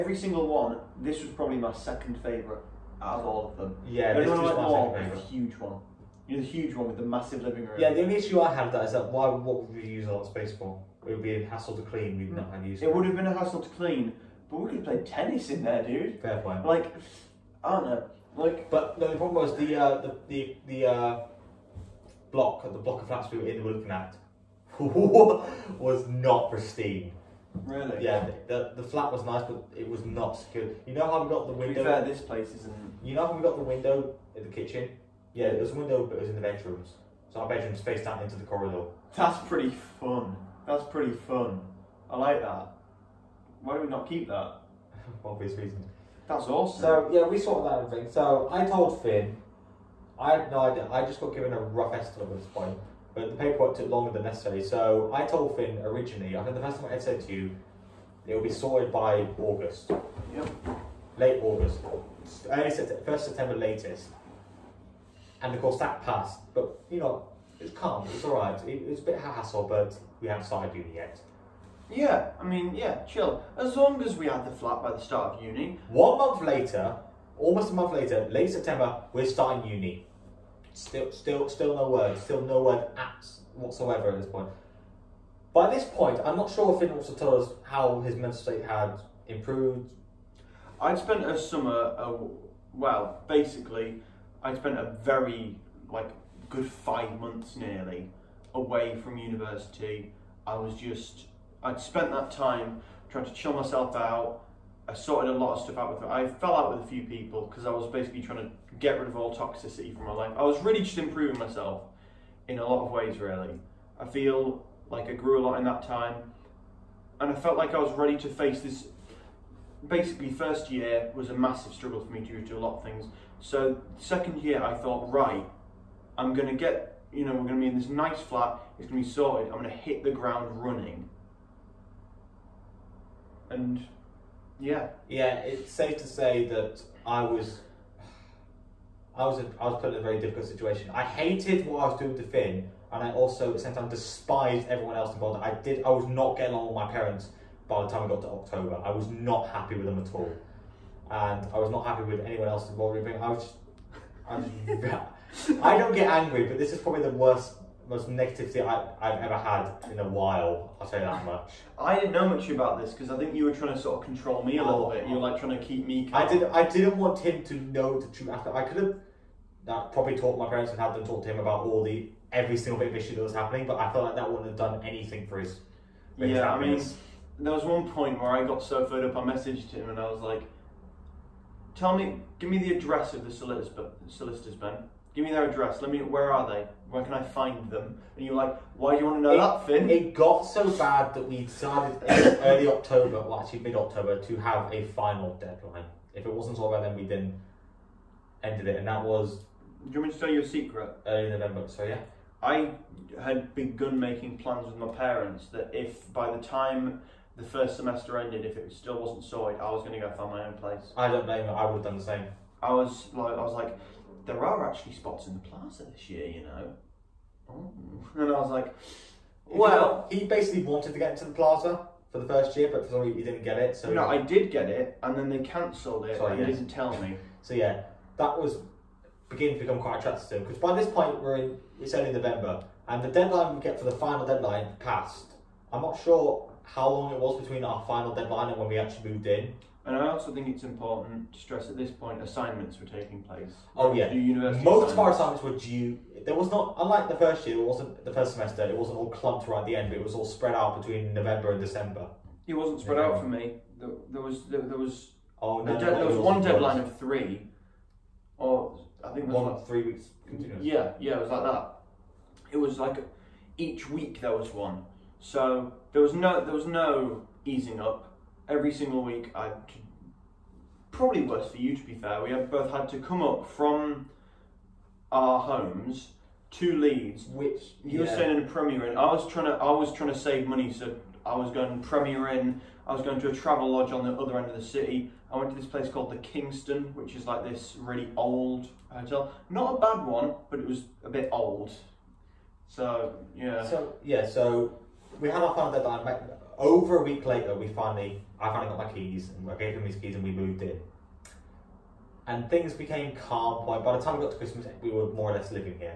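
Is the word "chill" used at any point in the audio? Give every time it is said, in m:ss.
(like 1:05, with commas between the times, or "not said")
1:13, 1:43.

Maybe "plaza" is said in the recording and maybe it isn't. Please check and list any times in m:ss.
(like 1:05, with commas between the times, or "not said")
3:35, 3:41.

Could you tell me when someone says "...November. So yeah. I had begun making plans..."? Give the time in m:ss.
3:21.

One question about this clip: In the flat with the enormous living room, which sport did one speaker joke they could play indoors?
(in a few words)
Tennis.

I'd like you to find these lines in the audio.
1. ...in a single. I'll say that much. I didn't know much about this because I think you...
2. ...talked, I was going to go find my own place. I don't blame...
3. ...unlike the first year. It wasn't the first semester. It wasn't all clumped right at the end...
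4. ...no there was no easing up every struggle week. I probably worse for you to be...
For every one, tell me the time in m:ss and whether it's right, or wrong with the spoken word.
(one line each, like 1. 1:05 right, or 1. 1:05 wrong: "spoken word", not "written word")
1. 2:39 wrong: "while", not "single"
2. 3:29 wrong: "sorted", not "talked"
3. 4:06 right
4. 4:26 wrong: "single", not "struggle".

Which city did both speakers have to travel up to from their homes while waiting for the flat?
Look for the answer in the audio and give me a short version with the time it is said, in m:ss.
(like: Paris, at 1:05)
Leeds, at 4:36.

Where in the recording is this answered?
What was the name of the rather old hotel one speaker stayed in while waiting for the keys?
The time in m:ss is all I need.
4:46.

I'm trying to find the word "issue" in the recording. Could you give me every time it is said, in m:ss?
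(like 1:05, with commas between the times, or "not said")
0:08, 2:52.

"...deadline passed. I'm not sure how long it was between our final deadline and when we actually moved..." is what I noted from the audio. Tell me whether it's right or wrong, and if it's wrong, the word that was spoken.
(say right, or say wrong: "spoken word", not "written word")
right.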